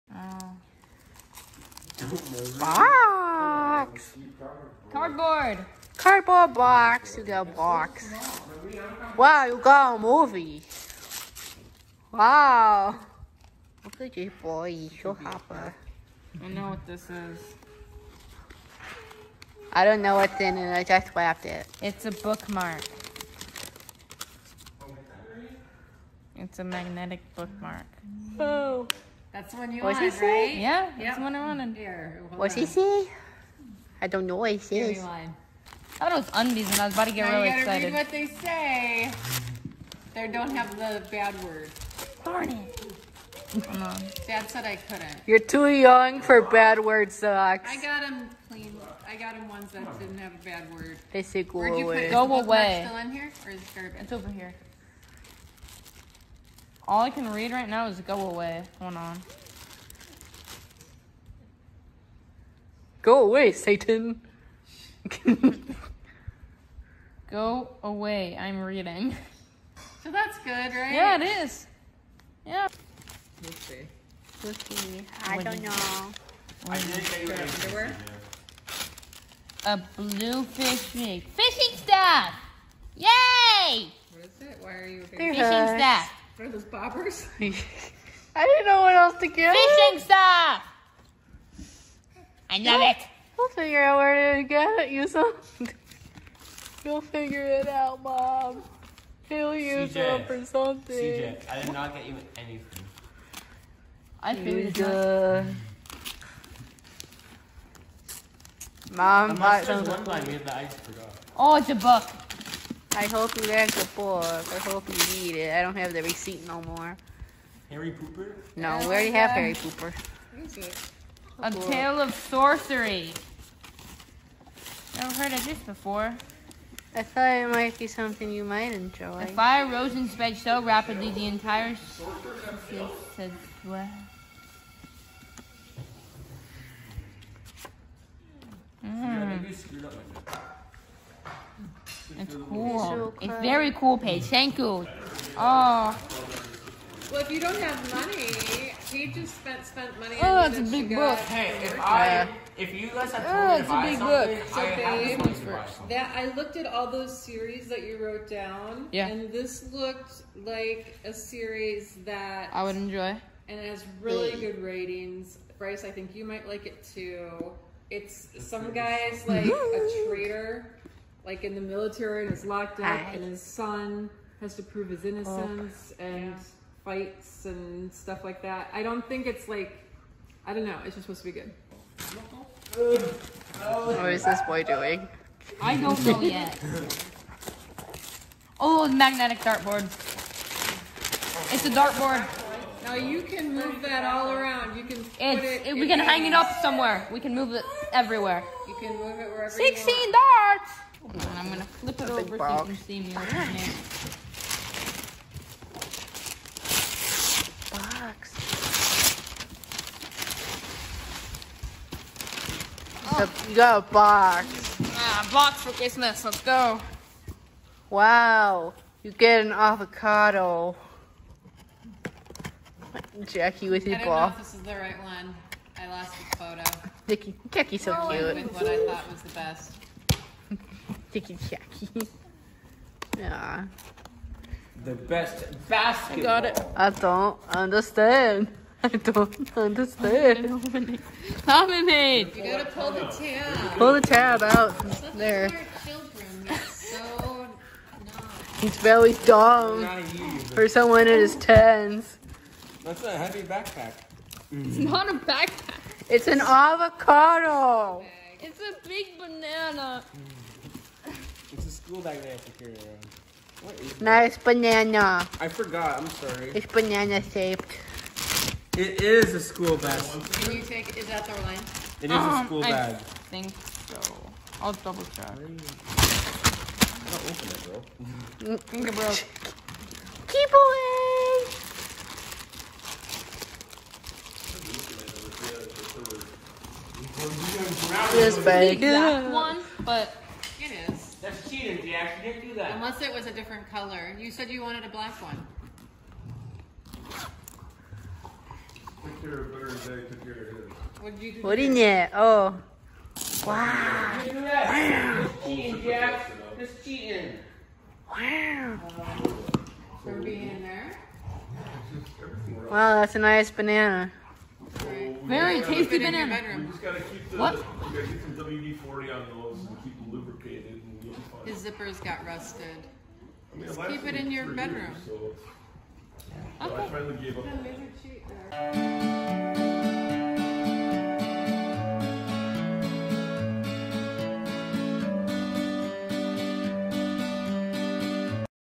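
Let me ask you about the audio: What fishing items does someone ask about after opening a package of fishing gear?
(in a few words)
Bobbers.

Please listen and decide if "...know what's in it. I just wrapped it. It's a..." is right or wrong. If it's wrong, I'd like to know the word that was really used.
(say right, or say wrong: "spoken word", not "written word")
right.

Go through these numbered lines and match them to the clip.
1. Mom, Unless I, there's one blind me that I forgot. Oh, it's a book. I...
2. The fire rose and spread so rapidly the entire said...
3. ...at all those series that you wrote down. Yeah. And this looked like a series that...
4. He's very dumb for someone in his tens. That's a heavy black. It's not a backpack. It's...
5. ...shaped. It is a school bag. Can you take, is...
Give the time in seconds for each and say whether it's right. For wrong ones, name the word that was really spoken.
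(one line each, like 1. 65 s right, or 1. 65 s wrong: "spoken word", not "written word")
1. 108 s right
2. 129 s right
3. 156 s right
4. 248 s wrong: "backpack", not "black"
5. 267 s right.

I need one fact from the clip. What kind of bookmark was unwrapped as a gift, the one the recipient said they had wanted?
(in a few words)
Magnetic bookmark.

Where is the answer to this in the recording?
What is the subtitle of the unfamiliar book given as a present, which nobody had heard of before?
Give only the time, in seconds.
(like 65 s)
121 s.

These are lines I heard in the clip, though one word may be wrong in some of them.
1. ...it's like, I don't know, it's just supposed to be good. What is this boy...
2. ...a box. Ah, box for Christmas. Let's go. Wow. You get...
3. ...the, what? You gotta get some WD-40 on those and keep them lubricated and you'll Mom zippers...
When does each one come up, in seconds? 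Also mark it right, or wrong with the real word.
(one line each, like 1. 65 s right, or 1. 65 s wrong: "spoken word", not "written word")
1. 179 s right
2. 213 s right
3. 317 s wrong: "His", not "Mom".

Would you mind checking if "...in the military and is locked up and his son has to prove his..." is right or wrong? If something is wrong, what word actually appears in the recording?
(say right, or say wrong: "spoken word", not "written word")
right.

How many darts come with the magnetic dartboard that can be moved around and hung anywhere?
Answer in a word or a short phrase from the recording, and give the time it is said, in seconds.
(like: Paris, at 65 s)
16, at 199 s.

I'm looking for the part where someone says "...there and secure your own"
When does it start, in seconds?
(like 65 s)
262 s.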